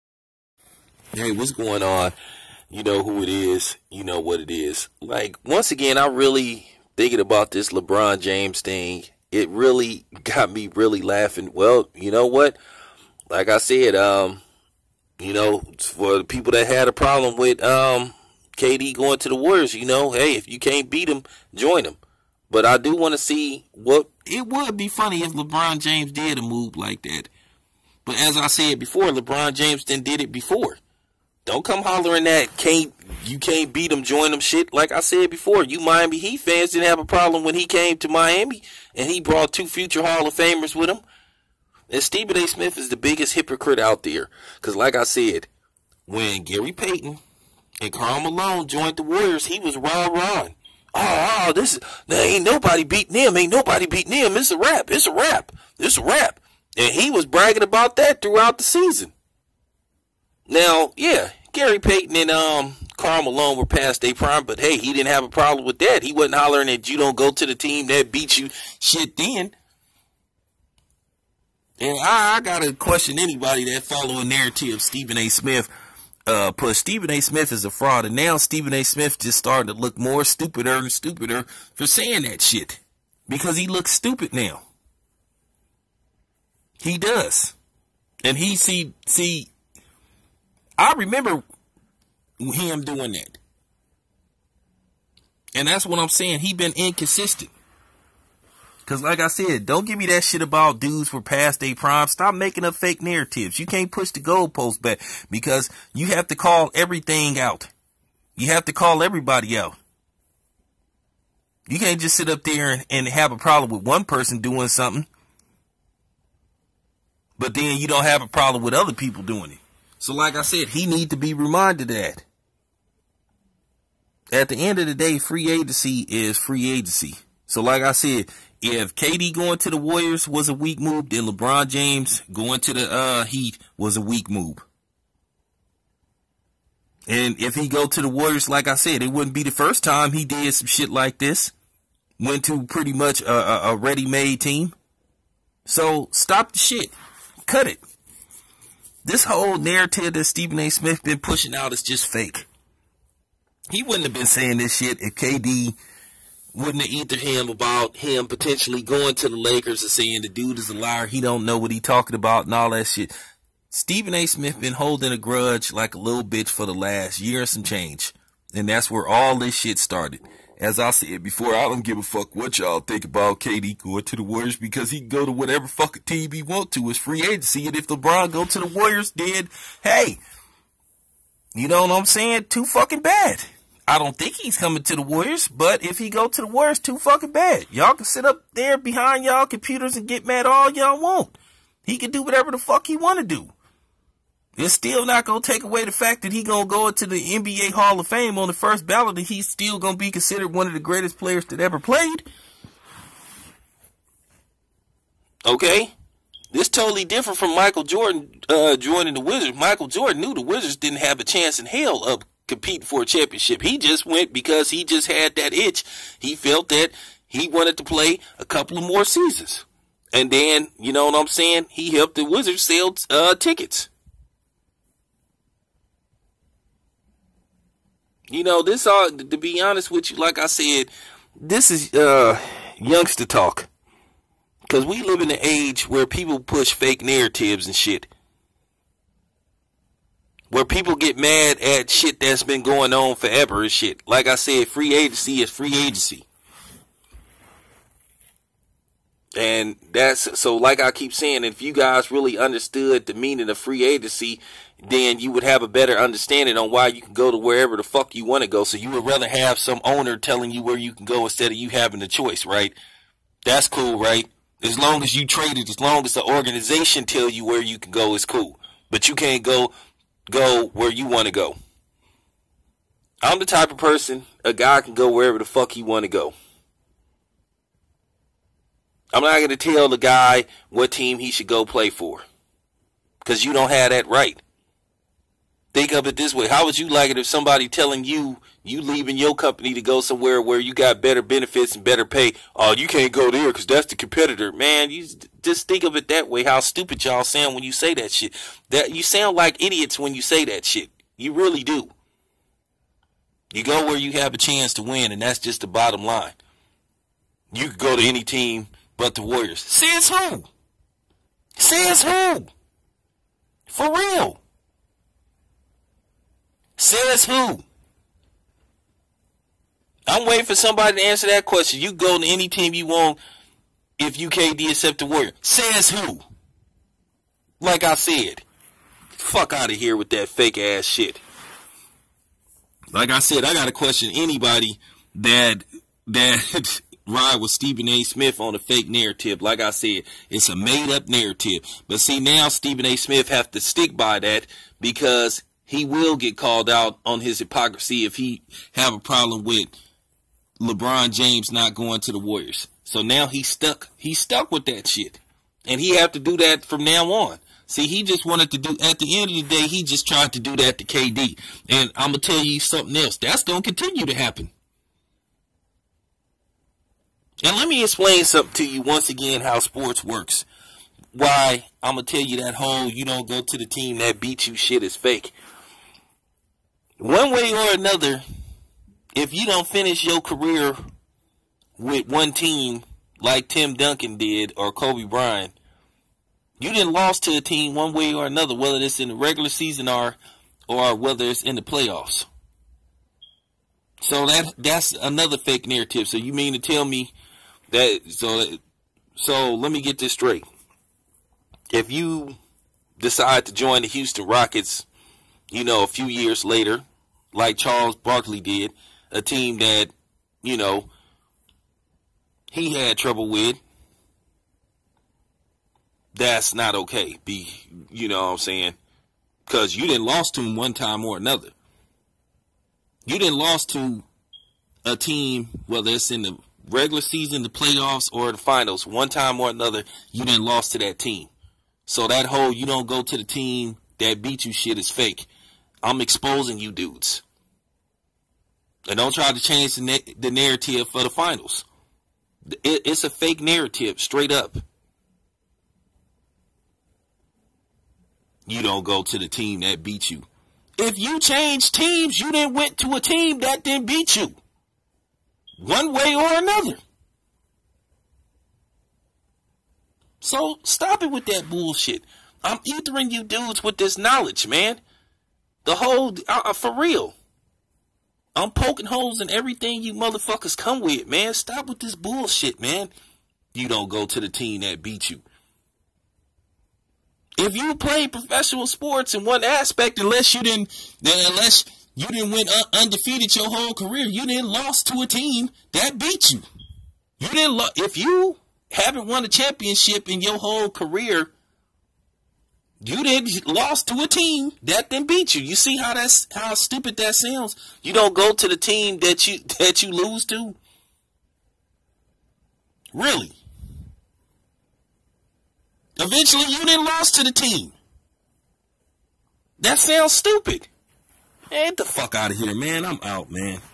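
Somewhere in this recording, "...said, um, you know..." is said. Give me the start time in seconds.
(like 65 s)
13 s.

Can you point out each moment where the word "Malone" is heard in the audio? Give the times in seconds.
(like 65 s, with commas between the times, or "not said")
48 s, 63 s.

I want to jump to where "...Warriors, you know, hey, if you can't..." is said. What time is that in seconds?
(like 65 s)
19 s.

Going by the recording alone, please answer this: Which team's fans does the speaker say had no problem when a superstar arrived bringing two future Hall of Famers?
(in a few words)
Miami Heat.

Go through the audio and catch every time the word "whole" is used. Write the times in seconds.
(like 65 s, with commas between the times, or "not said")
149 s, 372 s, 432 s, 465 s, 483 s, 490 s.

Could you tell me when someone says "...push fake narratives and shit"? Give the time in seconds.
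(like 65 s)
236 s.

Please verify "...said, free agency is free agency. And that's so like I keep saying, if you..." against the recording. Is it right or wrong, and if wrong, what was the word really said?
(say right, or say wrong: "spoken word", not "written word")
right.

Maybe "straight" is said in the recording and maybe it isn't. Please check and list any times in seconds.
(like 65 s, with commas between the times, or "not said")
400 s, 443 s.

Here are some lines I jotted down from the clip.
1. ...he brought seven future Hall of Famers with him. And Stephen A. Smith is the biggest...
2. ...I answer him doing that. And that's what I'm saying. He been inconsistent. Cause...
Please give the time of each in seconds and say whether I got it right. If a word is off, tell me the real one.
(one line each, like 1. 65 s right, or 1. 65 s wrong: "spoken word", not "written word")
1. 39 s wrong: "two", not "seven"
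2. 90 s wrong: "remember", not "answer".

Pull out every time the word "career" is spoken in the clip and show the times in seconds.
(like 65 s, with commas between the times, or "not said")
380 s, 483 s, 490 s.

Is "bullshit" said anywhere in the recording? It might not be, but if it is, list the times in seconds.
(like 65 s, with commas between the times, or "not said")
461 s, 471 s.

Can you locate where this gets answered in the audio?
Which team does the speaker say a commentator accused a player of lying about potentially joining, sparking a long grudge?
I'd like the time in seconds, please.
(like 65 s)
159 s.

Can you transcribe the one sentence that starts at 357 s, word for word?
See, he just wanted to do, at the end of the day, he just tried to do that to KD.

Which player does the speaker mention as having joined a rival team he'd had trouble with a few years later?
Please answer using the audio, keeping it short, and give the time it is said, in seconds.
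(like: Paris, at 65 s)
Charles Barkley, at 407 s.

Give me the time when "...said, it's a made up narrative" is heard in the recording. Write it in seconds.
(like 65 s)
339 s.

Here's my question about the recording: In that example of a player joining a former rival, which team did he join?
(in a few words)
Houston Rockets.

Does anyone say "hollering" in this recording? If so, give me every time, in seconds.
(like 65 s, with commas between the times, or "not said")
31 s, 66 s.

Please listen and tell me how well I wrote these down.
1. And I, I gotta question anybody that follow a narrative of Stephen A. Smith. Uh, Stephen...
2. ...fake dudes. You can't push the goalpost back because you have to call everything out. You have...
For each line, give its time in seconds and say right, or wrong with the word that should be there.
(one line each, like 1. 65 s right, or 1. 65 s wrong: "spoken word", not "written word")
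1. 71 s right
2. 102 s wrong: "narratives", not "dudes".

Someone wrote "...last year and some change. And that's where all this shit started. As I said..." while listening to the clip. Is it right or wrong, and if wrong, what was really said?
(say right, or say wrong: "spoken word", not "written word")
right.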